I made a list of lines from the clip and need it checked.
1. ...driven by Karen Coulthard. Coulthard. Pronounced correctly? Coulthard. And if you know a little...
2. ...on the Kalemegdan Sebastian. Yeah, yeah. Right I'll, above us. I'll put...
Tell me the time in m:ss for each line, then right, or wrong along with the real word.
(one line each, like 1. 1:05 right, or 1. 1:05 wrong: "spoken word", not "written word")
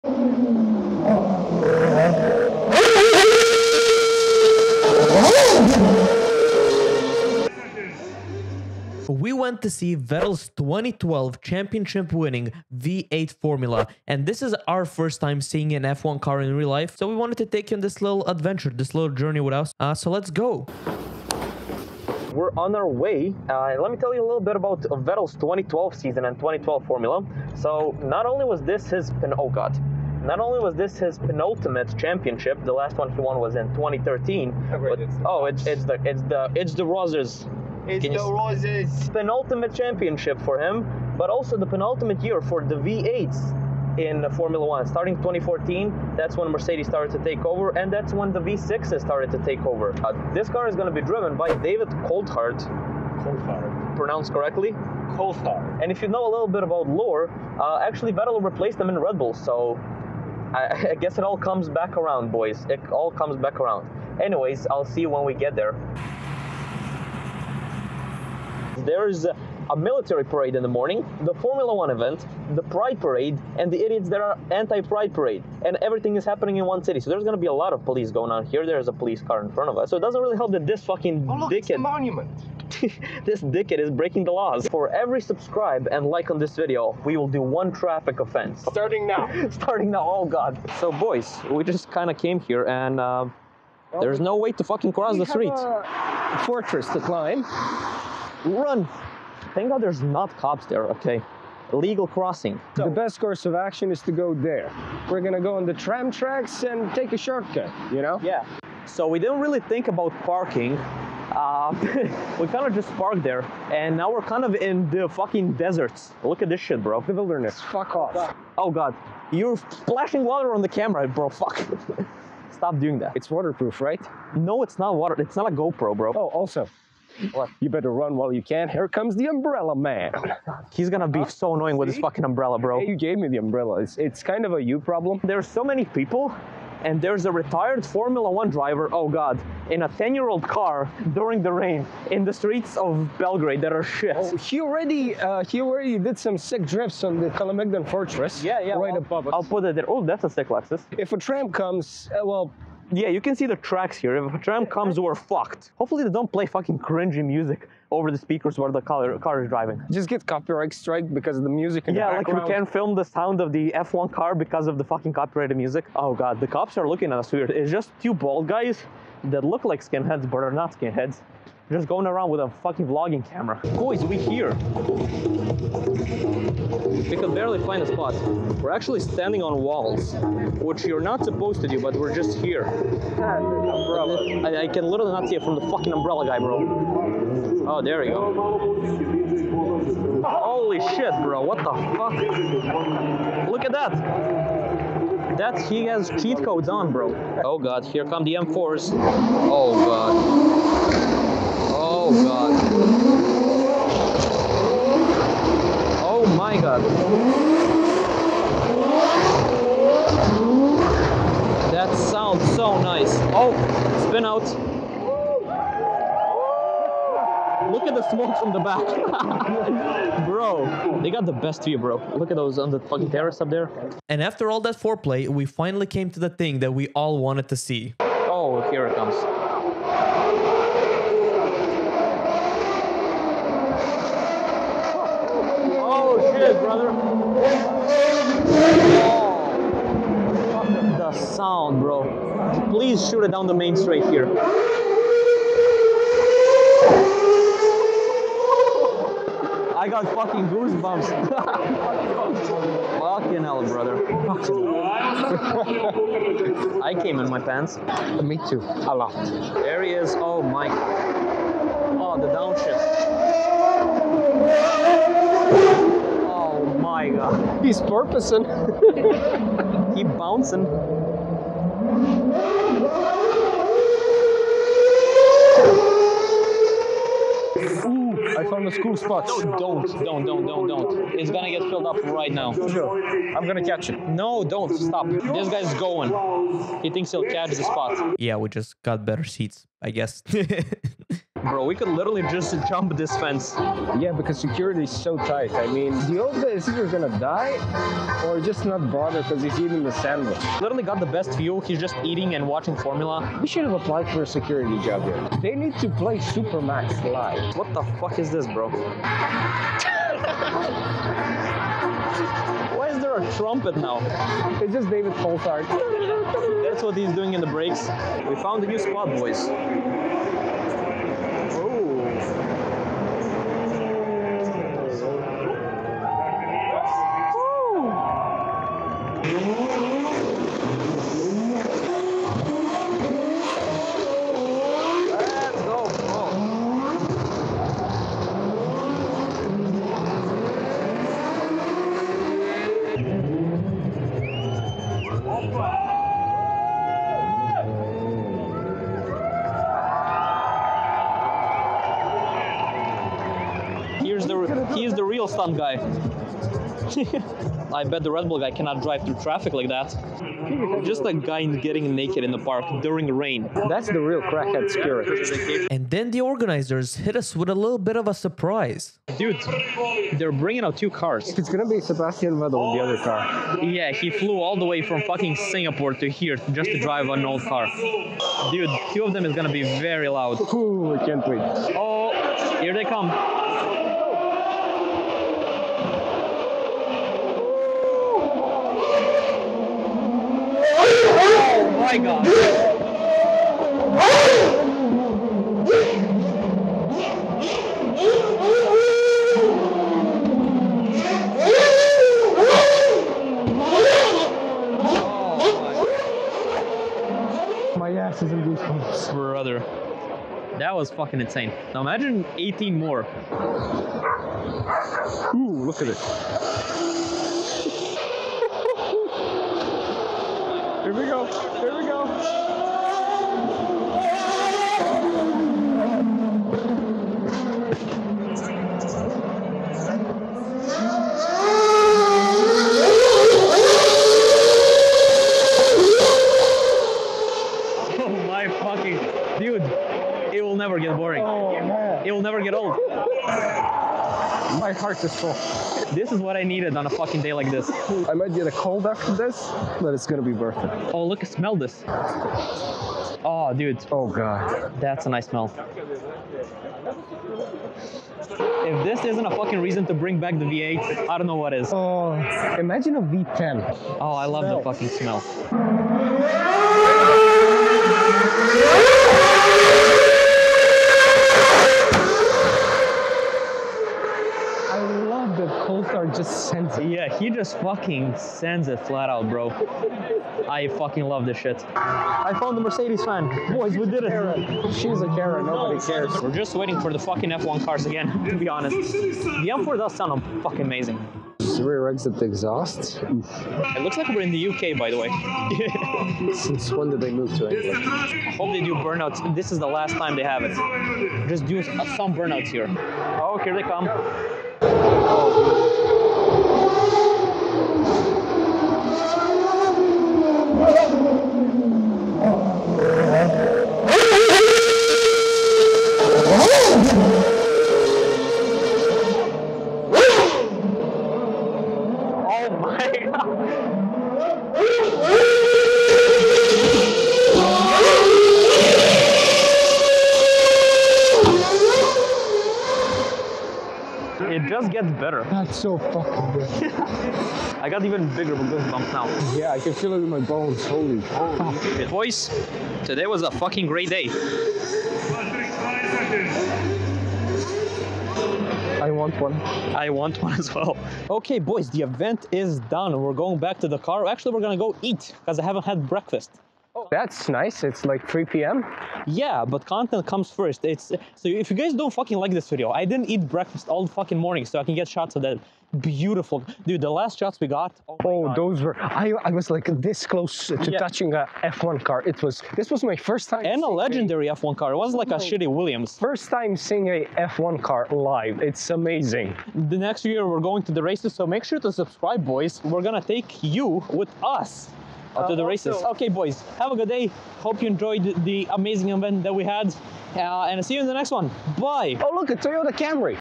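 1. 0:51 wrong: "David", not "Karen"
2. 2:27 wrong: "Fortress", not "Sebastian".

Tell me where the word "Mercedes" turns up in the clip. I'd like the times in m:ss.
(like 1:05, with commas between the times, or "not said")
0:46, 8:02.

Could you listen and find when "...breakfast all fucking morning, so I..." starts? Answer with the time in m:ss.
9:23.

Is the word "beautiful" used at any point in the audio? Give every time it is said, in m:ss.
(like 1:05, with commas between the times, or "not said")
9:25.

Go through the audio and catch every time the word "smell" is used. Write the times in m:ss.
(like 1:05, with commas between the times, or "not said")
7:31, 7:35, 7:44.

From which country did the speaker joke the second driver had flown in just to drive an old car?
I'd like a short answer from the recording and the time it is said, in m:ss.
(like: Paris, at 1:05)
Singapore, at 6:15.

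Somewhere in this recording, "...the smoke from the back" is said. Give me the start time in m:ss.
3:37.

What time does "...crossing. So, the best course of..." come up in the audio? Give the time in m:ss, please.
1:42.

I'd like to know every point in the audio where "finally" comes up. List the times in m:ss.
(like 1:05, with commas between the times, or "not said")
3:45.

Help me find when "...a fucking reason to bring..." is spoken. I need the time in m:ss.
7:39.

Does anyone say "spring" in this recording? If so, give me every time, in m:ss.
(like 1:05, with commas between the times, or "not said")
not said.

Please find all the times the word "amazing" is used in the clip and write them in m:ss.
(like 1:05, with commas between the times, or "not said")
8:10, 9:38, 9:48.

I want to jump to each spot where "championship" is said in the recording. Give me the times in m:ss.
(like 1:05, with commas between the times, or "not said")
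0:11, 0:31, 0:39.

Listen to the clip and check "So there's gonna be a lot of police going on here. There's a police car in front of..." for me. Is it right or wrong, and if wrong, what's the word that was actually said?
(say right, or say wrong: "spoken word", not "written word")
right.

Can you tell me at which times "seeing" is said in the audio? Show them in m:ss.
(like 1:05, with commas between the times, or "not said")
0:15, 9:36.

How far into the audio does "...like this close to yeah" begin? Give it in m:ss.
9:29.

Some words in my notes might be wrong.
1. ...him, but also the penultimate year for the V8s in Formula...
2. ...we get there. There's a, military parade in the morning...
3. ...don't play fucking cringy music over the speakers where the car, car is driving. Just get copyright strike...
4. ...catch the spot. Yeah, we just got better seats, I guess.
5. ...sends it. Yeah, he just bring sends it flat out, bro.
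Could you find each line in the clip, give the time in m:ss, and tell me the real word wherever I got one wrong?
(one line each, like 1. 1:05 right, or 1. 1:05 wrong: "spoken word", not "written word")
1. 0:40 right
2. 1:05 right
3. 2:36 right
4. 4:47 right
5. 7:56 wrong: "fucking", not "bring".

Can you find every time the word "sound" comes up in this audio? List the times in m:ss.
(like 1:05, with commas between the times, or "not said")
2:43, 3:31, 4:01, 8:09.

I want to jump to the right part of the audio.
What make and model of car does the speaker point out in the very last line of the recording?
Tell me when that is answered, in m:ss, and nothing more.
9:52.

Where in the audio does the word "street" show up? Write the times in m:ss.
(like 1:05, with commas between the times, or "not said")
1:35, 2:22.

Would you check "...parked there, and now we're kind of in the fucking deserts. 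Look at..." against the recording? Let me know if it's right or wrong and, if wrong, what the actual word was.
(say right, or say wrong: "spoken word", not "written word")
right.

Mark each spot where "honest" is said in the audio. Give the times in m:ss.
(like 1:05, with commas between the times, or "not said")
8:08.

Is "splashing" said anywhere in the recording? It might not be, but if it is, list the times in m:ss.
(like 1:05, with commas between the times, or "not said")
1:59.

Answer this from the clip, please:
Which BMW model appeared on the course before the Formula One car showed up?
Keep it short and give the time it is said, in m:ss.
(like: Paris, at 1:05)
M4, at 3:18.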